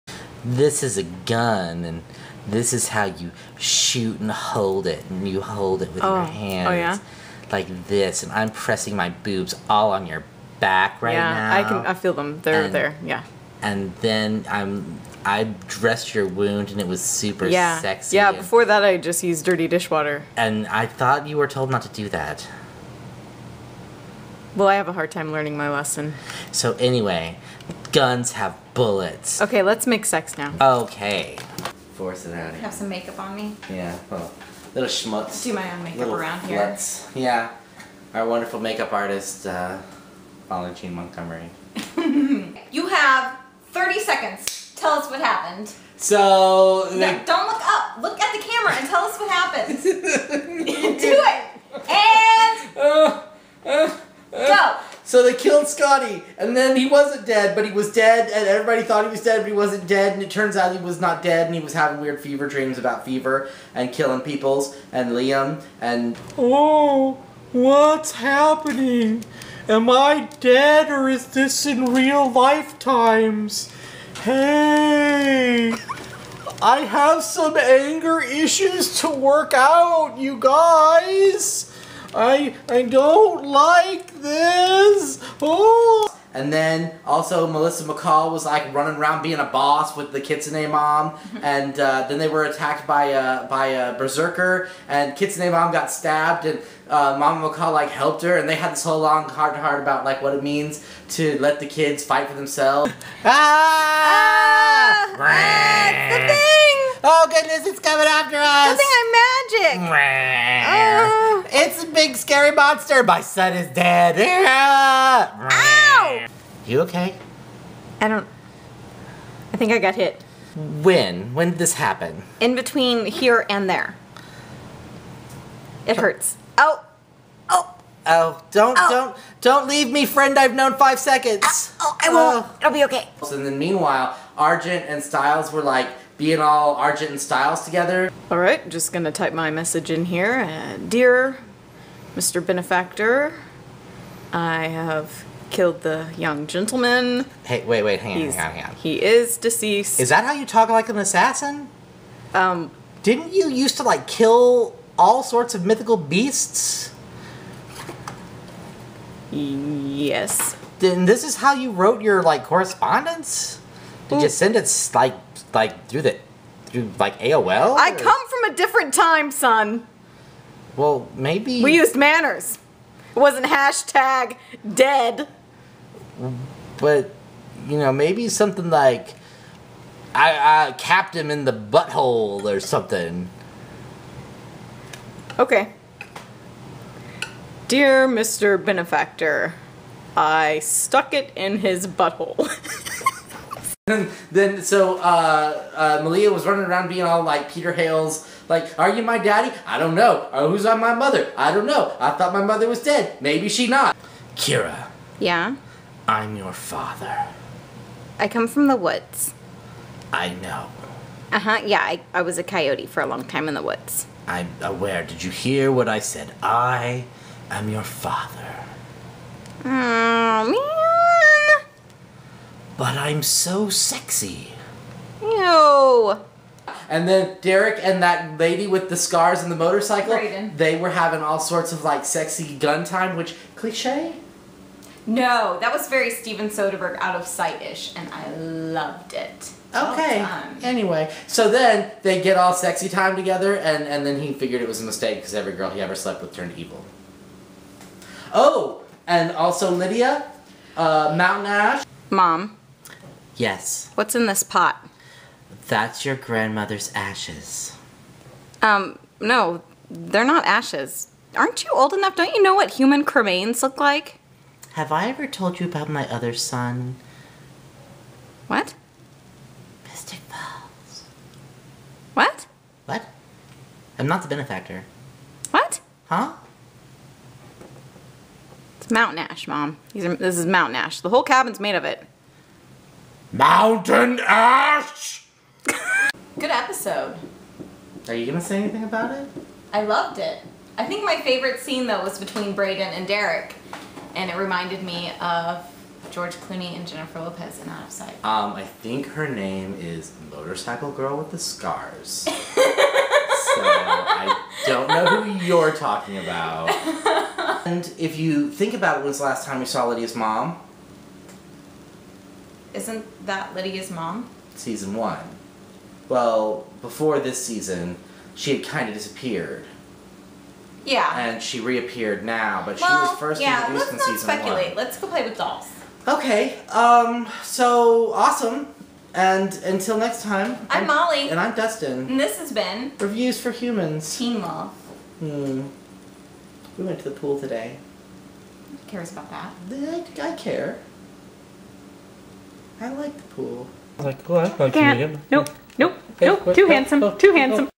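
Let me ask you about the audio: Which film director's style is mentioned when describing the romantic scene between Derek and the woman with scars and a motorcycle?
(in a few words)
Steven Soderbergh.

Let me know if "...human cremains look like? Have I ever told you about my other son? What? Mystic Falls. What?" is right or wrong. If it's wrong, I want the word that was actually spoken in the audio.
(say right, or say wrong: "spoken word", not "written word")
right.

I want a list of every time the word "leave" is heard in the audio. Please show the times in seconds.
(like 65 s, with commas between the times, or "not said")
129 s.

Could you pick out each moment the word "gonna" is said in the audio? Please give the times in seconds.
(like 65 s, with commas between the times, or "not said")
138 s, 288 s.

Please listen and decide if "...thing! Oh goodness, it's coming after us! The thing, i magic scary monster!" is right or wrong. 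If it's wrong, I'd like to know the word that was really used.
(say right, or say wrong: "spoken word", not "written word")
right.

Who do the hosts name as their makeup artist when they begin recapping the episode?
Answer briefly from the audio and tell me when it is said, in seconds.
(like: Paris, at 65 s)
Valentine Montgomery, at 40 s.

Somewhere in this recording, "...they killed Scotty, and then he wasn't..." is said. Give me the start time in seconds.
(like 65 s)
55 s.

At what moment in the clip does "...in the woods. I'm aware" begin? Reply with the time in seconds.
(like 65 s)
213 s.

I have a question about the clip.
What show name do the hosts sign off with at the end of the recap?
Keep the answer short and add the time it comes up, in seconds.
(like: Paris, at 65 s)
Reviews for Humans, at 332 s.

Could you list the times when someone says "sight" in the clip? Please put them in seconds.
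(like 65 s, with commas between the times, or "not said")
237 s, 297 s.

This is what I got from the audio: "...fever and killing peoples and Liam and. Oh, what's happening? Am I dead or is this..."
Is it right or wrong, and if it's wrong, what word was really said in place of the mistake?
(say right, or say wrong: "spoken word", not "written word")
right.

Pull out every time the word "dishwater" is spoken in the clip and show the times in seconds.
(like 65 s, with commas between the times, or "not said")
19 s.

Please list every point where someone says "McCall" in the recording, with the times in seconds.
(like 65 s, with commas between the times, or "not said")
87 s, 97 s.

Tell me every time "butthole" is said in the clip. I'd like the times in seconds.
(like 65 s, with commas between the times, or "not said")
181 s, 191 s.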